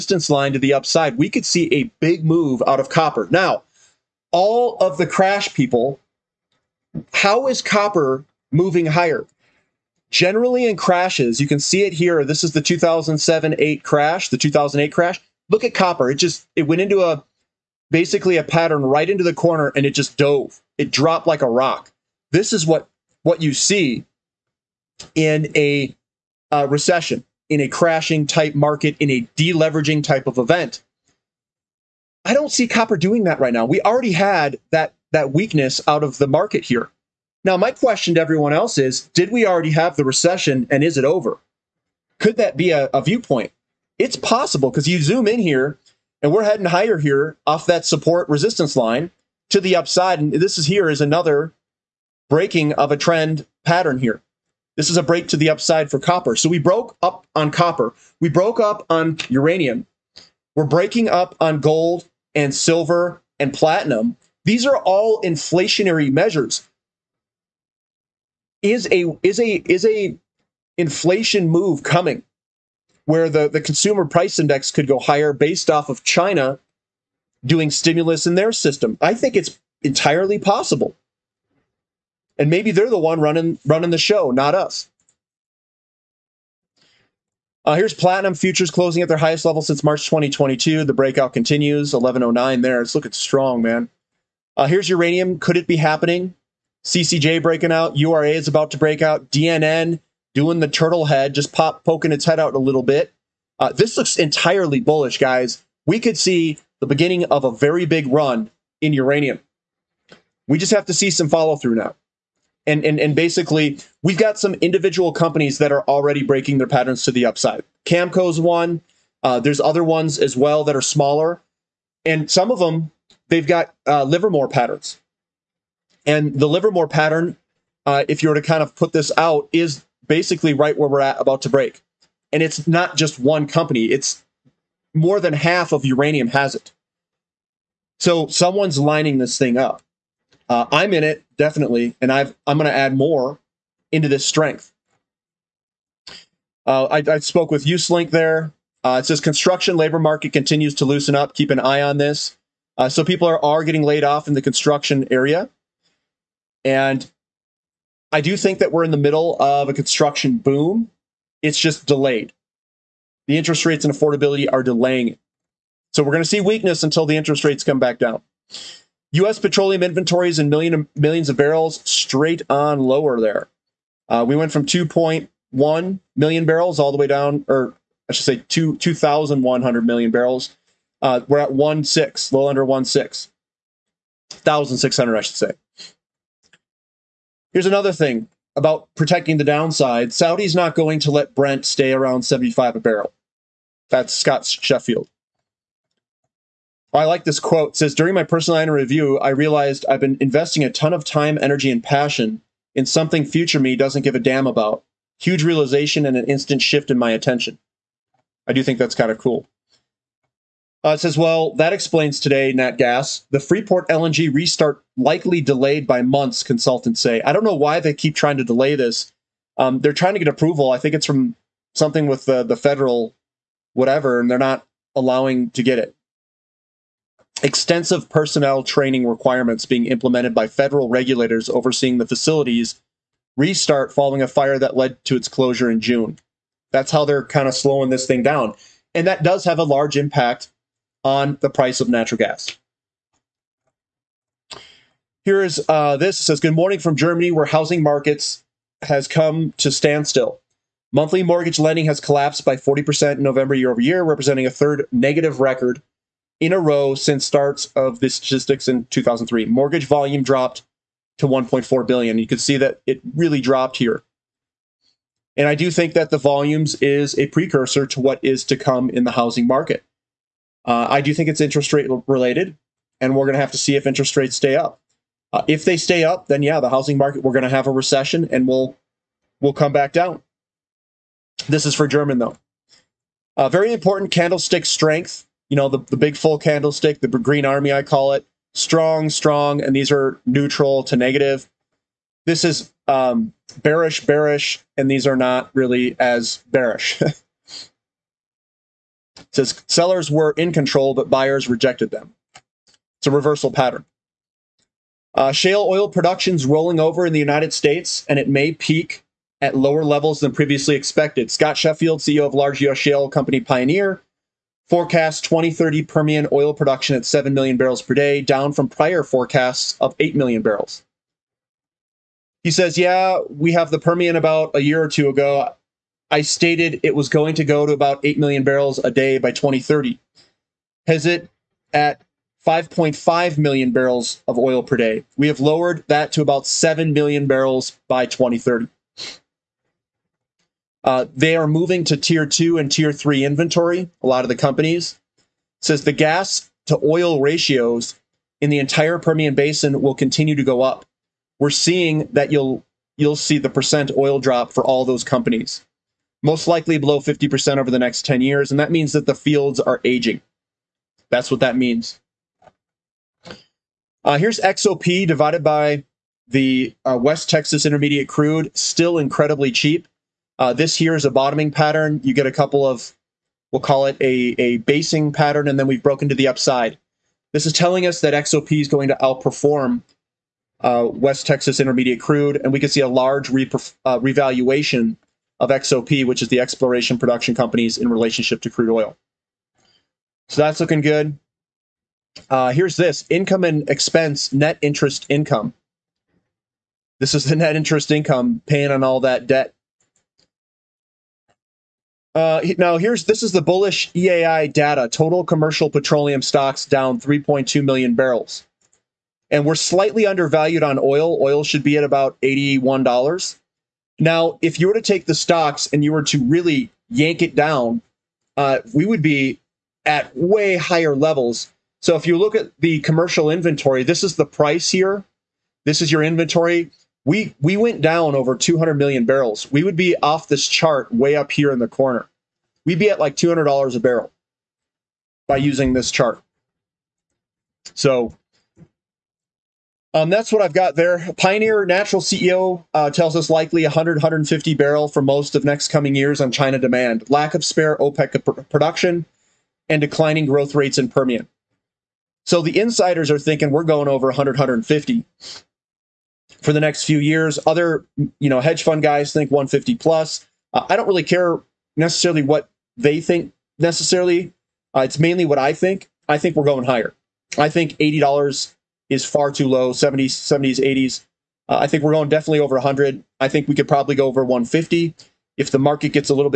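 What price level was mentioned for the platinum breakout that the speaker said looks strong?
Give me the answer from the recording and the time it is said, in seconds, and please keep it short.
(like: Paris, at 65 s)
1109, at 91 s.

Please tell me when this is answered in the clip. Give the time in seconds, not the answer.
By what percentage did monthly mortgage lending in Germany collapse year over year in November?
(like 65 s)
252 s.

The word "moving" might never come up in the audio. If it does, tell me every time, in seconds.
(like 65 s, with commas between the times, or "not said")
8 s, 341 s.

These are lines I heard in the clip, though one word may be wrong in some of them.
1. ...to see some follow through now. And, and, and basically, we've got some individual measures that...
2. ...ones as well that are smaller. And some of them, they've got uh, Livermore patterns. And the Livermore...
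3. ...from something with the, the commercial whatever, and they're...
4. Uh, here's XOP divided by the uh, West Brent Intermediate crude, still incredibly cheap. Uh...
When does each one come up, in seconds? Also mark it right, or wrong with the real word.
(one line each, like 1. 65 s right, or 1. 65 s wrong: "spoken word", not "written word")
1. 110 s wrong: "companies", not "measures"
2. 119 s right
3. 221 s wrong: "federal", not "commercial"
4. 364 s wrong: "Texas", not "Brent".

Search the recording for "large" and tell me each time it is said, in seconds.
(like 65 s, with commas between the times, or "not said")
239 s, 312 s, 382 s.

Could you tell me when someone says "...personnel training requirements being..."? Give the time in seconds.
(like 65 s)
228 s.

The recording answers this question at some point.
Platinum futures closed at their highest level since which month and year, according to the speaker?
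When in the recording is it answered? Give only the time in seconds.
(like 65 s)
89 s.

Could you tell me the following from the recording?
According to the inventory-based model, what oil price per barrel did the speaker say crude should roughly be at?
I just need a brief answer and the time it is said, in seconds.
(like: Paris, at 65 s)
$81, at 412 s.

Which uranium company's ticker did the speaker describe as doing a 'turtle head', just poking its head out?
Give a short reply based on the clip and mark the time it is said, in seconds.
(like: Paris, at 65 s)
DNN, at 99 s.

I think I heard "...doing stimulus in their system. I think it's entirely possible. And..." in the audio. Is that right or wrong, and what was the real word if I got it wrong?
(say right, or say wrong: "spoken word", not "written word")
right.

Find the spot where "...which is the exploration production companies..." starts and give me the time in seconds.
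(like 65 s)
386 s.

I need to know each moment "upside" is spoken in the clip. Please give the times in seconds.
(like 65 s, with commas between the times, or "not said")
0 s, 49 s, 55 s, 117 s, 376 s.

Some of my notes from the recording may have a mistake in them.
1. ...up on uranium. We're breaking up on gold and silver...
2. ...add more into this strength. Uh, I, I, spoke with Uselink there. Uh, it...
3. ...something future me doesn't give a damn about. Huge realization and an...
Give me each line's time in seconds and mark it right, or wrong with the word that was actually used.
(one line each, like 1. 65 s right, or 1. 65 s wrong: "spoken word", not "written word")
1. 58 s right
2. 142 s right
3. 202 s right.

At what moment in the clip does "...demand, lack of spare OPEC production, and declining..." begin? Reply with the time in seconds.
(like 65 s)
446 s.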